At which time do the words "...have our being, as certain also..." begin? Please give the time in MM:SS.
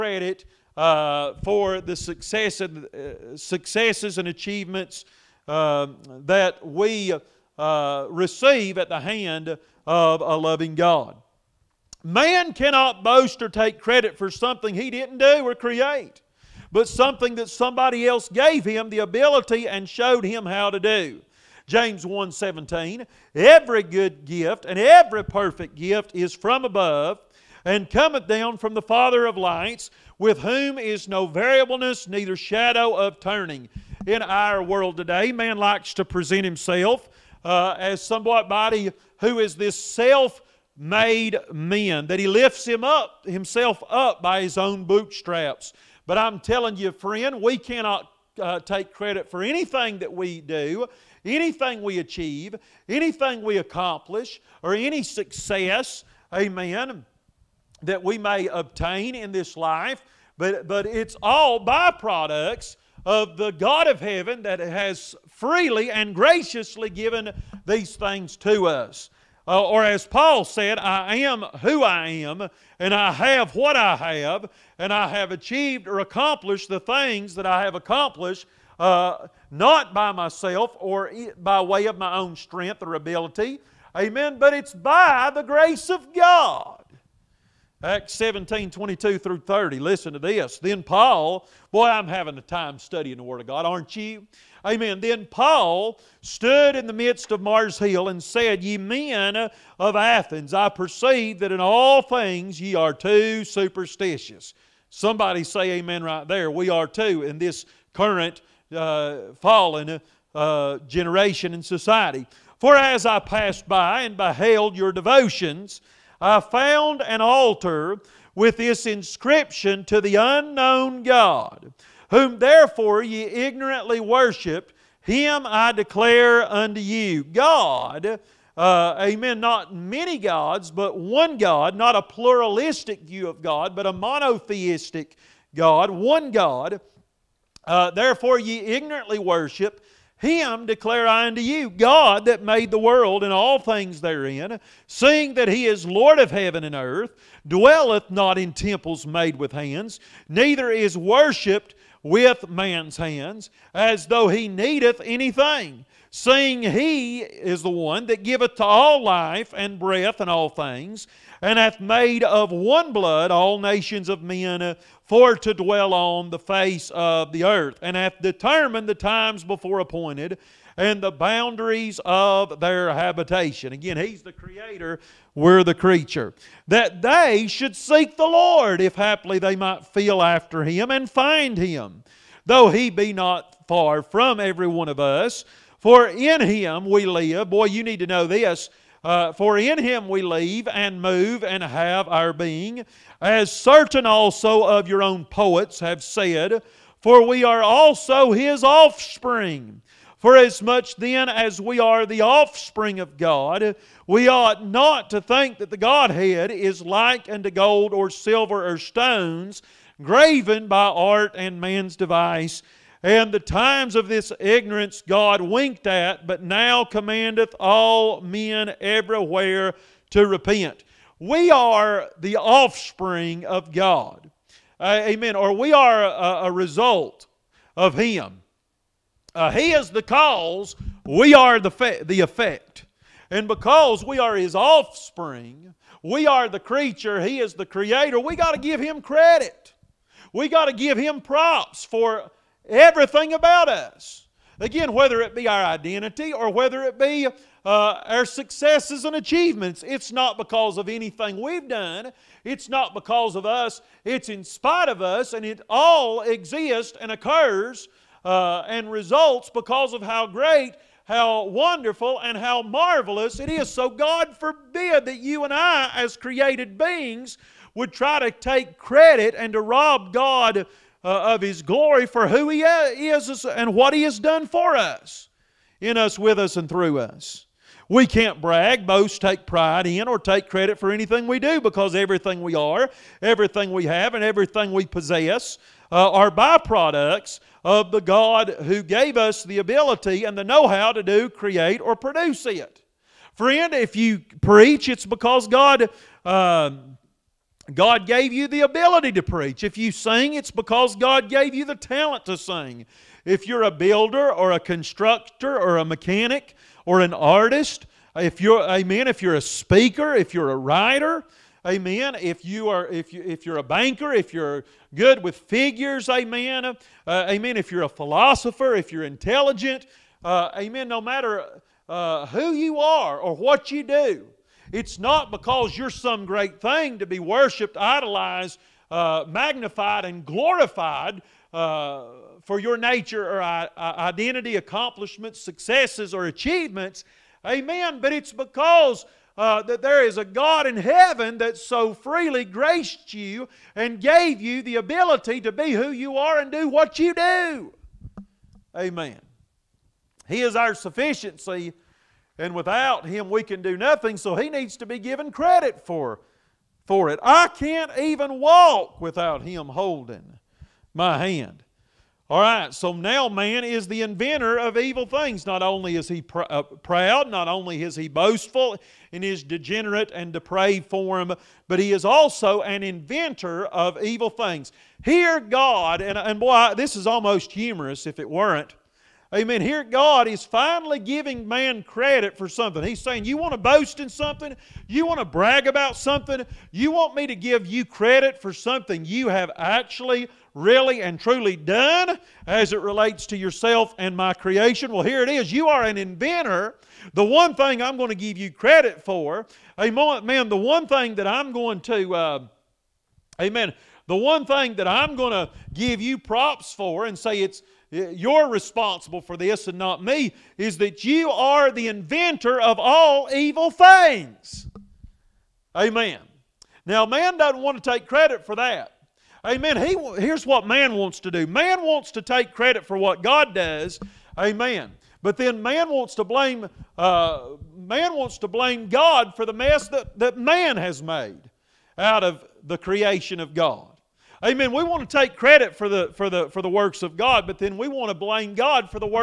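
03:11.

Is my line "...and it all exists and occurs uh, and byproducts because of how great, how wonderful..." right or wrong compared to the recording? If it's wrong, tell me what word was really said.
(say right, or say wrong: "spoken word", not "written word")
wrong: "results", not "byproducts".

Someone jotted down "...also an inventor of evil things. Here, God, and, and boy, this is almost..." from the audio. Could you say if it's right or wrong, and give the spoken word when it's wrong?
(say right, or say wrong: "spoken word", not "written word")
right.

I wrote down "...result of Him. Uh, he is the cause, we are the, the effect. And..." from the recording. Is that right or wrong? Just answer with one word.
right.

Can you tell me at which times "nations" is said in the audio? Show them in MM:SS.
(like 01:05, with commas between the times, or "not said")
02:43.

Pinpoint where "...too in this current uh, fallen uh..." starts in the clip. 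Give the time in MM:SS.
01:46.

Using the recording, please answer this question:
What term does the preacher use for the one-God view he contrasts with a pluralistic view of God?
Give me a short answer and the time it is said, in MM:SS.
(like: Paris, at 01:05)
Monotheistic, at 02:13.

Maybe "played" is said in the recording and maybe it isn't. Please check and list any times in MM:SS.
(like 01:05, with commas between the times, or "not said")
not said.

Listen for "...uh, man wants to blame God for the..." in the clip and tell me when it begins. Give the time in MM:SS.
07:06.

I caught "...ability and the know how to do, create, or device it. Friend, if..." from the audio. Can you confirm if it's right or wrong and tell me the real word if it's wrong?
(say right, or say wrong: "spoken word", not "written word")
wrong: "produce", not "device".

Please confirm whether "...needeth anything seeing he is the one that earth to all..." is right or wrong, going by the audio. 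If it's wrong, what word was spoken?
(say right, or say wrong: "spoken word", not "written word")
wrong: "giveth", not "earth".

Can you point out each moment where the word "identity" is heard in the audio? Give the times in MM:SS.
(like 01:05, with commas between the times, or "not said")
04:05, 05:33.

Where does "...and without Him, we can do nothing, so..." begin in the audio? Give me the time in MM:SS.
05:52.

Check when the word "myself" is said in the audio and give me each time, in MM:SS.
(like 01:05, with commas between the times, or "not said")
01:20.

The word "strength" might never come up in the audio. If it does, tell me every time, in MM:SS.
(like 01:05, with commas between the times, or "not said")
01:22.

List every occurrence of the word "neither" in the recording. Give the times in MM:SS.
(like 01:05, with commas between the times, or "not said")
00:32, 02:30.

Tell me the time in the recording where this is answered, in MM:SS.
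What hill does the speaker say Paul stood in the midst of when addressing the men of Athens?
01:37.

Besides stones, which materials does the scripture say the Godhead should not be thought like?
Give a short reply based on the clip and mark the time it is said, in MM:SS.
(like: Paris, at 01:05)
Gold or silver, at 03:27.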